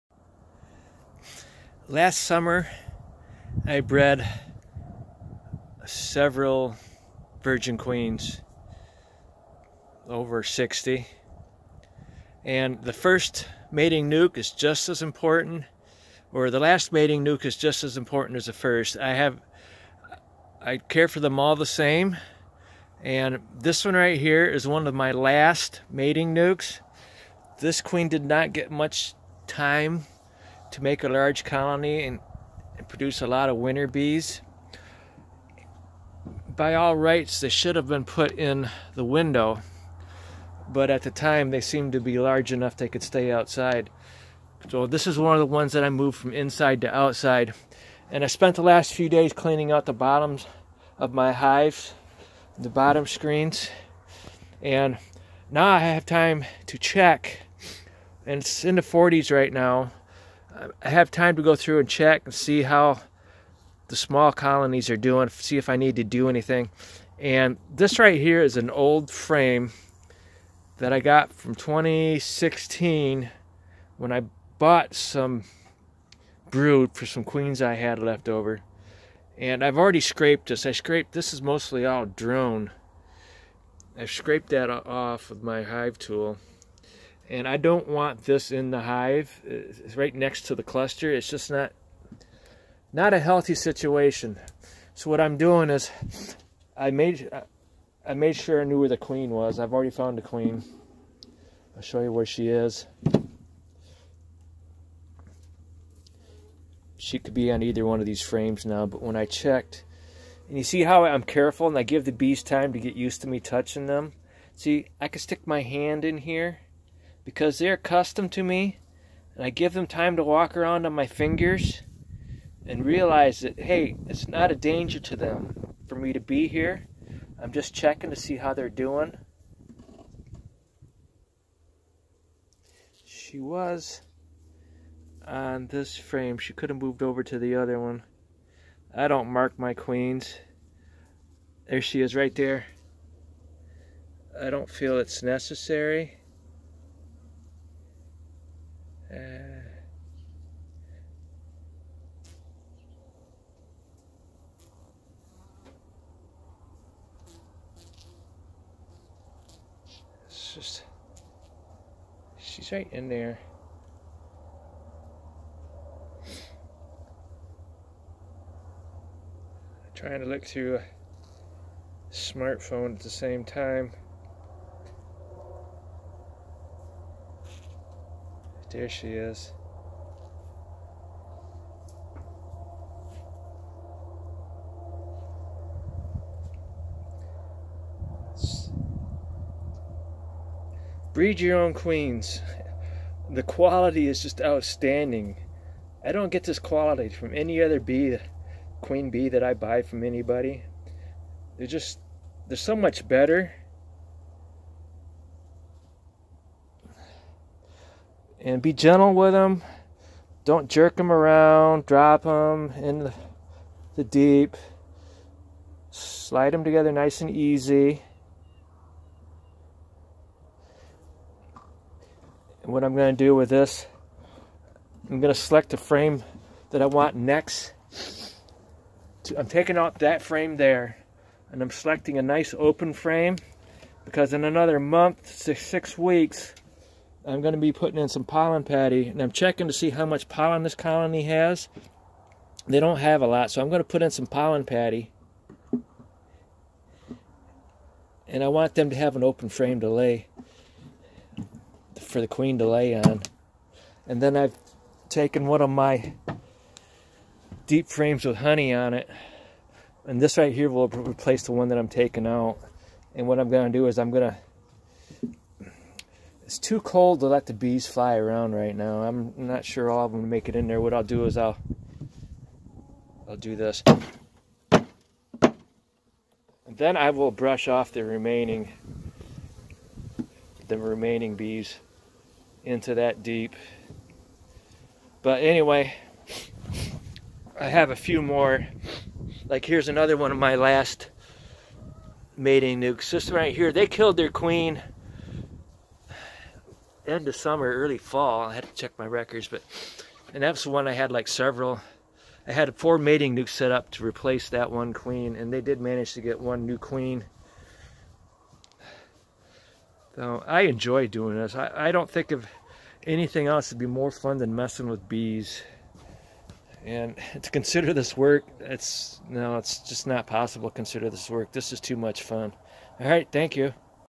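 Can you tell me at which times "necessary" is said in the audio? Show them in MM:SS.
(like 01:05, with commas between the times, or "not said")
02:25.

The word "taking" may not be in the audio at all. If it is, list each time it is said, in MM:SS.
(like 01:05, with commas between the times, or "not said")
03:49, 04:21.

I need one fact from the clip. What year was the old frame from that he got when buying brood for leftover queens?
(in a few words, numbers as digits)
2016.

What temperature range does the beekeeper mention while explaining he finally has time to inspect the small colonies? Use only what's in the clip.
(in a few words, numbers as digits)
40s.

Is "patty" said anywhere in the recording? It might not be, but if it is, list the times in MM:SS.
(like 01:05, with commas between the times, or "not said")
03:58, 04:04.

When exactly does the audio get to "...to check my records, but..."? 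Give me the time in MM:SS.
04:58.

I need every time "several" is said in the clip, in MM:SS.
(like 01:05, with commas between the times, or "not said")
00:05, 05:01.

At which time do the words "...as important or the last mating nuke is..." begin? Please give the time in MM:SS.
00:14.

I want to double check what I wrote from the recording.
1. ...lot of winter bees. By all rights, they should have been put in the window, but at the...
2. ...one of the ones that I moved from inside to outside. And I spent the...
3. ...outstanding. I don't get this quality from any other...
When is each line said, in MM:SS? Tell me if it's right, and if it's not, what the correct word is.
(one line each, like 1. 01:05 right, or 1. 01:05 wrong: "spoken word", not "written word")
1. 00:33 right
2. 00:45 right
3. 03:14 right.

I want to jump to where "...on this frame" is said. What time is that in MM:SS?
02:15.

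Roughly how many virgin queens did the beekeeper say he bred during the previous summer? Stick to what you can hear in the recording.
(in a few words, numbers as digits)
over 60.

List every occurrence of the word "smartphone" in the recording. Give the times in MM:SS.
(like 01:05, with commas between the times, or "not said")
02:52.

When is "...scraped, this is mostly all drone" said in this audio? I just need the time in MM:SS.
01:20.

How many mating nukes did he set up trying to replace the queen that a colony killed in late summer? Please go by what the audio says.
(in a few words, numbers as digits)
4.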